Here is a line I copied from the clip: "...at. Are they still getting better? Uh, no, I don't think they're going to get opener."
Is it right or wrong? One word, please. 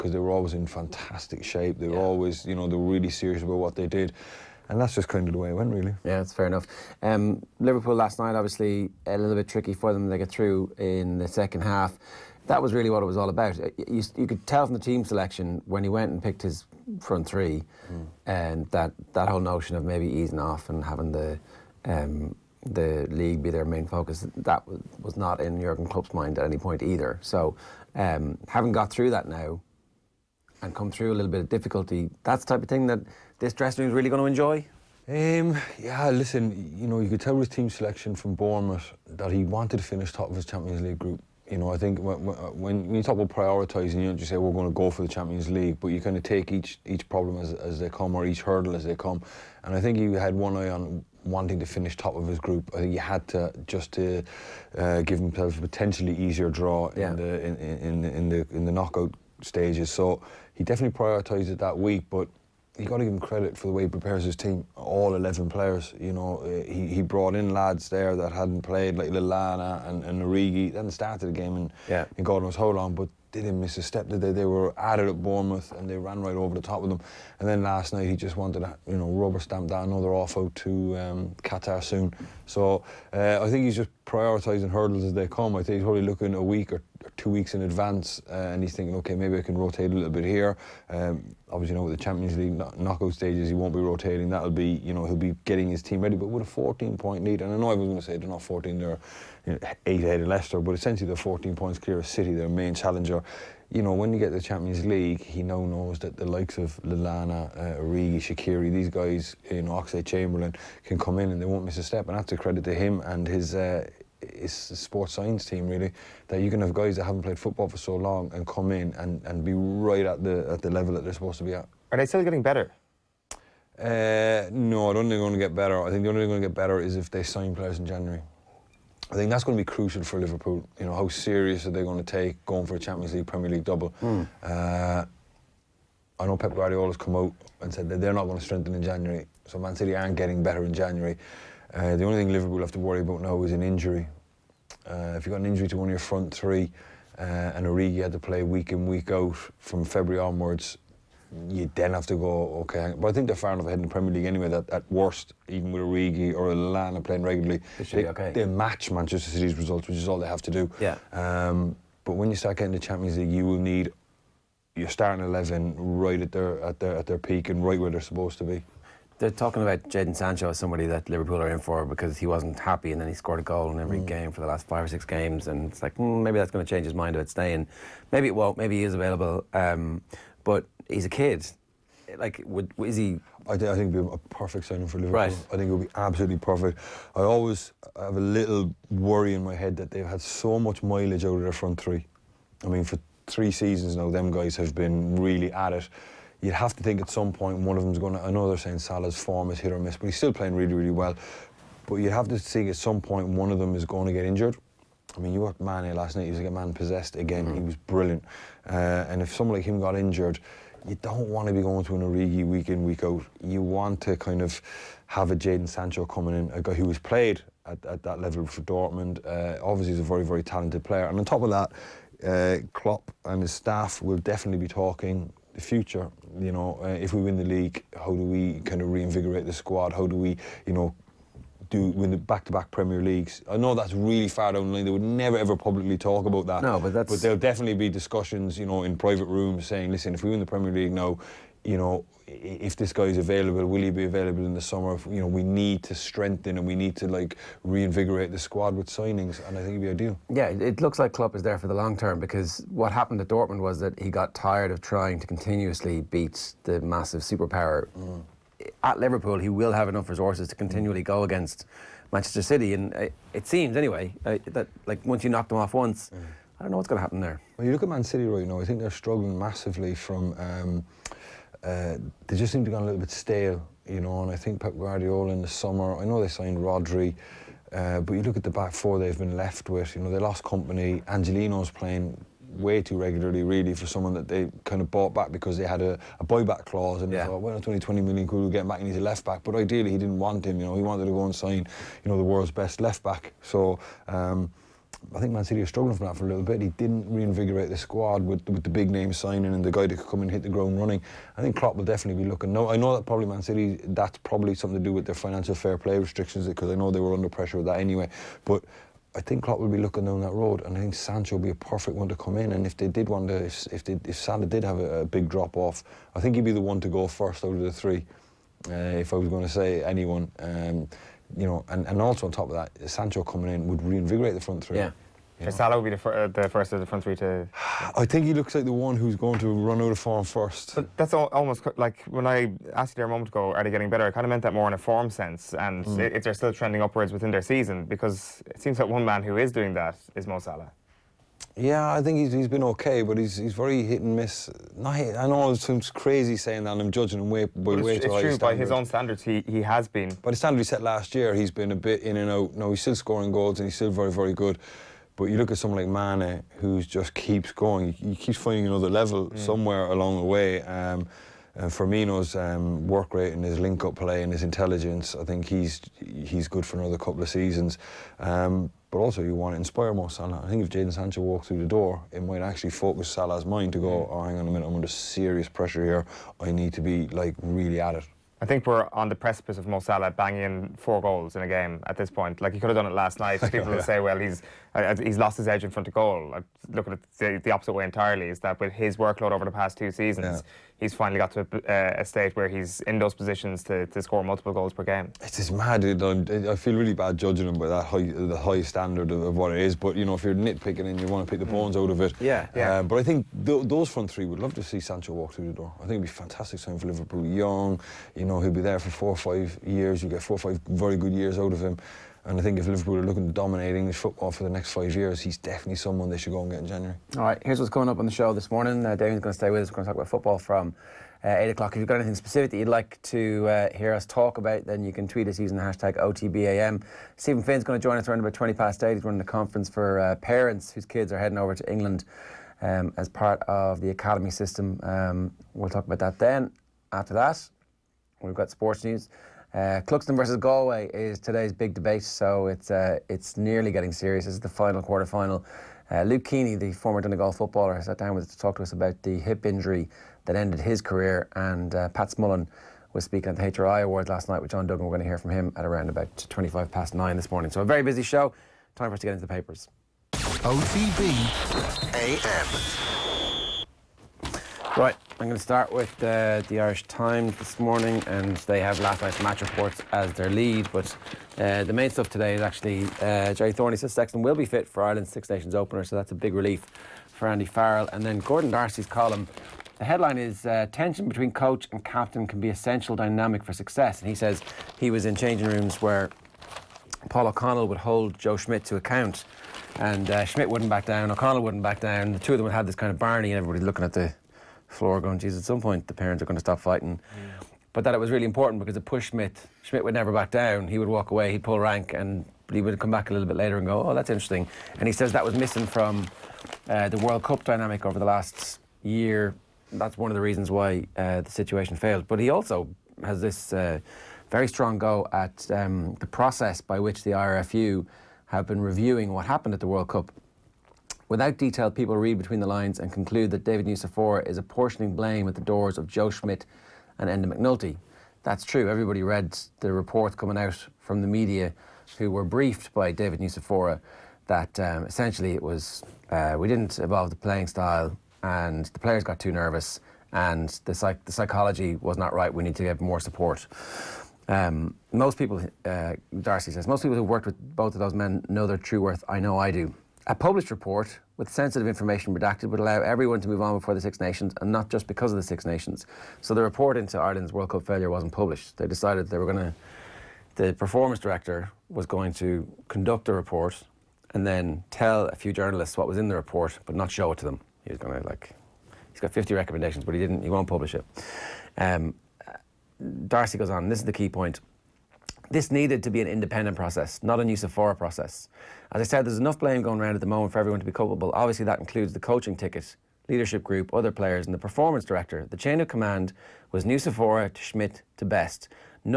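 wrong.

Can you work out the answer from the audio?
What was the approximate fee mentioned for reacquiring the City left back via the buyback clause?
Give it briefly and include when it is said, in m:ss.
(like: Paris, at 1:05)
20 million, at 4:47.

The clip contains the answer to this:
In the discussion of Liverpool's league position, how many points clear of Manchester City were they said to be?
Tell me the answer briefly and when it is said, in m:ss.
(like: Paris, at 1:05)
14, at 1:41.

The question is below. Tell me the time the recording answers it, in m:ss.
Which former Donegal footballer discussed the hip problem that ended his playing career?
7:26.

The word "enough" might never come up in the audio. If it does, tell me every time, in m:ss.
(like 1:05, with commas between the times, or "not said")
0:06, 2:33, 4:19, 9:39.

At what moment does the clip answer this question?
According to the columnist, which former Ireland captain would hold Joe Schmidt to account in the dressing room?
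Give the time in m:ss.
8:07.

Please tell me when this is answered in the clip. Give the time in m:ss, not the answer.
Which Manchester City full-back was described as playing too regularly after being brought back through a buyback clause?
4:41.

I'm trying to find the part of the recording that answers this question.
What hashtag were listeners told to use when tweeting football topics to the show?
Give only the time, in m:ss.
7:05.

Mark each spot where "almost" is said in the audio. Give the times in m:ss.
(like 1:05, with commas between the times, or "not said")
5:31.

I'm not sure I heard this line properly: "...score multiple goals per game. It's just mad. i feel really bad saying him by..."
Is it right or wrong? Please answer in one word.
wrong.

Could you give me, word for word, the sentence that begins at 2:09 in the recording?
I think that's going to be crucial for Liverpool.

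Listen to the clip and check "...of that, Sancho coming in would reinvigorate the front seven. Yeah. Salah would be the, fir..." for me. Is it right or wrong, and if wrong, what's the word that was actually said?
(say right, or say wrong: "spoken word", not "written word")
wrong: "three", not "seven".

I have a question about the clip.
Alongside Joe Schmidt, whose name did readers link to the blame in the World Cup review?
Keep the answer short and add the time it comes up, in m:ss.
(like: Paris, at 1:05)
Enda McNulty, at 8:47.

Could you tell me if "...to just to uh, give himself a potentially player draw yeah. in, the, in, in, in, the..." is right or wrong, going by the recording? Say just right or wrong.
wrong.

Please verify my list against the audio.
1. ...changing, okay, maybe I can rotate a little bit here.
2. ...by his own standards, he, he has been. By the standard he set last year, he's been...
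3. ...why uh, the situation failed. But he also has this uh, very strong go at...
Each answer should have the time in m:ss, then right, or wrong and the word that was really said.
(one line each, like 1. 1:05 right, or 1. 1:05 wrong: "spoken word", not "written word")
1. 1:28 wrong: "thinking", not "changing"
2. 5:48 right
3. 8:30 right.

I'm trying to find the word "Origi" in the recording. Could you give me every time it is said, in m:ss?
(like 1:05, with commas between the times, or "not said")
1:10, 1:47, 2:27, 2:35, 3:32.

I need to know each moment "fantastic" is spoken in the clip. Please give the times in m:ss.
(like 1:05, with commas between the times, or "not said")
0:00, 6:46.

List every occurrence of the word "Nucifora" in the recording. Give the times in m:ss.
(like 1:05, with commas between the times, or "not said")
8:43, 8:53, 9:37, 9:46.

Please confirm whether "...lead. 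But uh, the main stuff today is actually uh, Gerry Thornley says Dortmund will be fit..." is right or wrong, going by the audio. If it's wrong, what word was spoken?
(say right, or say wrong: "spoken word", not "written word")
wrong: "Sexton", not "Dortmund".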